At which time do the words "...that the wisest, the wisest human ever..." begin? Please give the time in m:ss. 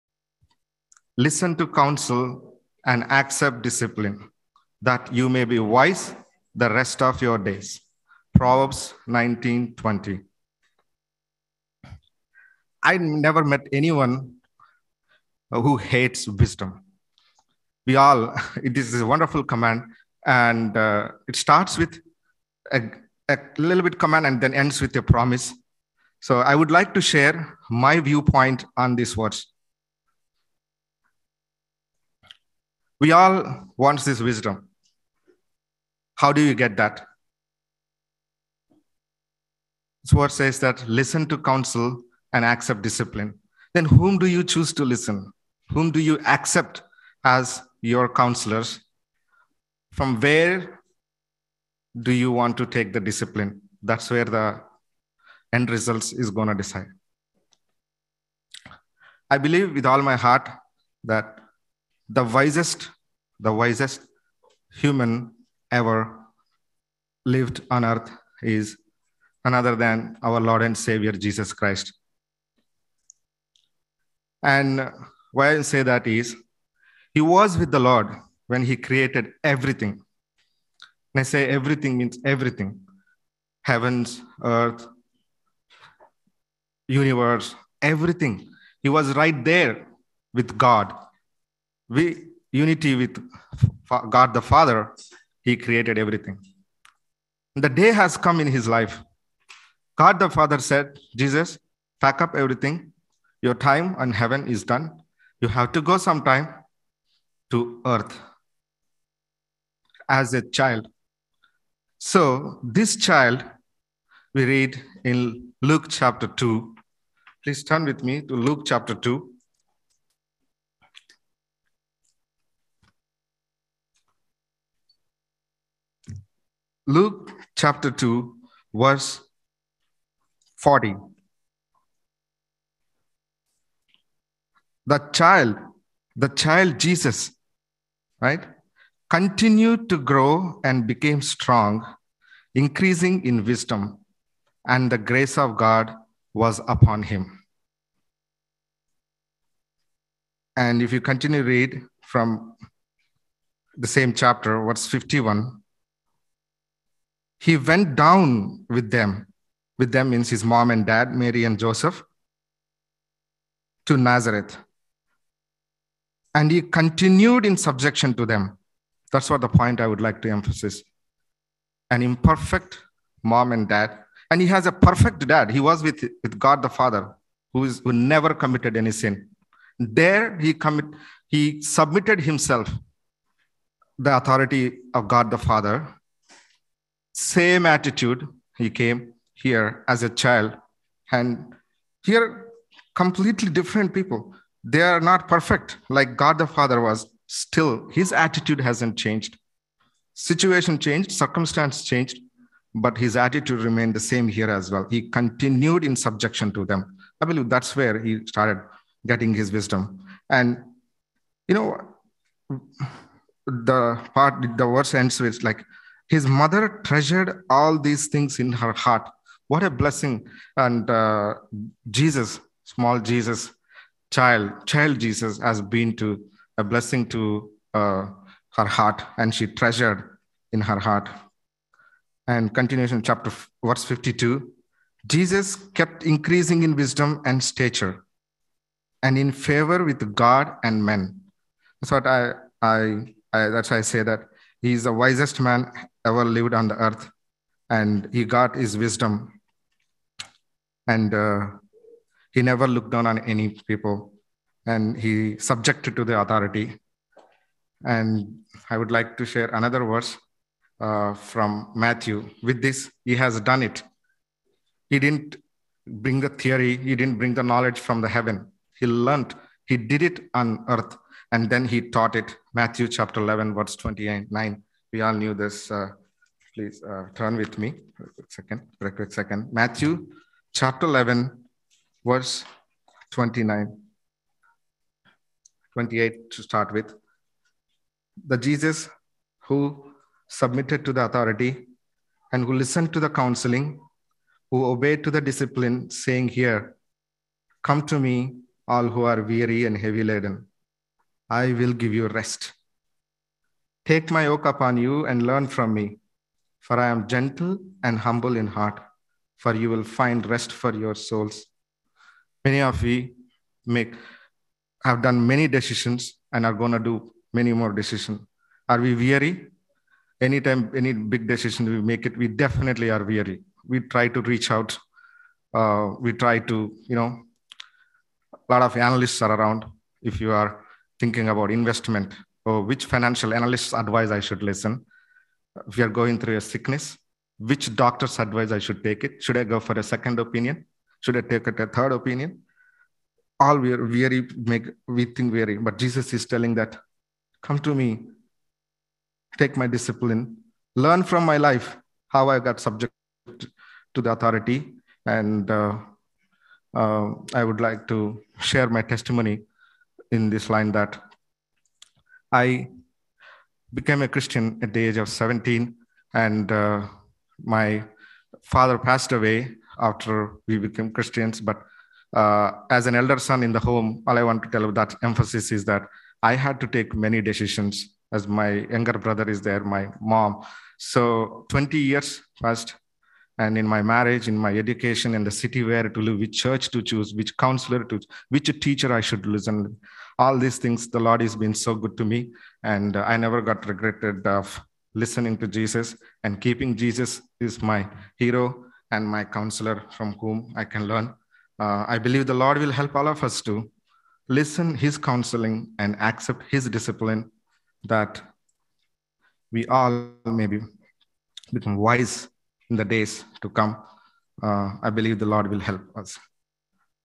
1:01.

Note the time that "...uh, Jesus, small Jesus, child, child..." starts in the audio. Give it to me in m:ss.
3:40.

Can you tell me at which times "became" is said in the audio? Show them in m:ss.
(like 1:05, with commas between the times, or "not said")
2:20, 6:03, 6:10.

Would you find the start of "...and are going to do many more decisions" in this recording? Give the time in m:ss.
5:16.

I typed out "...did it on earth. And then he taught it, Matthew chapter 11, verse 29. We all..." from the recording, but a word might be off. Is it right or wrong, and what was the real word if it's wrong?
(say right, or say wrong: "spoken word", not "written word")
right.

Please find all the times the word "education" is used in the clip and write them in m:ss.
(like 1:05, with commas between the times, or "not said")
6:24.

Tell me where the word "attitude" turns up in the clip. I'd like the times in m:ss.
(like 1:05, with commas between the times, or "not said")
3:07, 3:18, 3:23.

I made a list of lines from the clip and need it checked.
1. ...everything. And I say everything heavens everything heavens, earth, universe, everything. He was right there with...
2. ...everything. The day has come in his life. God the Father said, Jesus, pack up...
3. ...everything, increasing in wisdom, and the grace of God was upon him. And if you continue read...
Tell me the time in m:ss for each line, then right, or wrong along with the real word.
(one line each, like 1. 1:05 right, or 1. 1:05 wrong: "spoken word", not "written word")
1. 1:19 wrong: "means", not "heavens"
2. 1:35 right
3. 2:21 wrong: "strong", not "everything".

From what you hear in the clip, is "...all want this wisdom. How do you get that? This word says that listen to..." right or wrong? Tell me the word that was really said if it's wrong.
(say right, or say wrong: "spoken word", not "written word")
right.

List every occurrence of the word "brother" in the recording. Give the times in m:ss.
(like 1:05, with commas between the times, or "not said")
6:18.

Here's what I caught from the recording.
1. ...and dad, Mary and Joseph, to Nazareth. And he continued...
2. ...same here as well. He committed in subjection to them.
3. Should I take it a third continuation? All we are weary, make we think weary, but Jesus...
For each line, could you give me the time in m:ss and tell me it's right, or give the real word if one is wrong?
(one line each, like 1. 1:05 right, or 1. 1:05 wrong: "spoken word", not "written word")
1. 2:40 right
2. 3:24 wrong: "continued", not "committed"
3. 5:41 wrong: "opinion", not "continuation".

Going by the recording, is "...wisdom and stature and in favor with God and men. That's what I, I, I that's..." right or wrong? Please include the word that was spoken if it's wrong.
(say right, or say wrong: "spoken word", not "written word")
right.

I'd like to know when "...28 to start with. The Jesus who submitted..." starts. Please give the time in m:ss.
4:45.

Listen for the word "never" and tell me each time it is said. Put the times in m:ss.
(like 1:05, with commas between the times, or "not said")
0:12, 2:57, 4:12, 6:33.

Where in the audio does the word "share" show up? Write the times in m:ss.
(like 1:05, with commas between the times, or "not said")
0:27, 4:19, 5:58.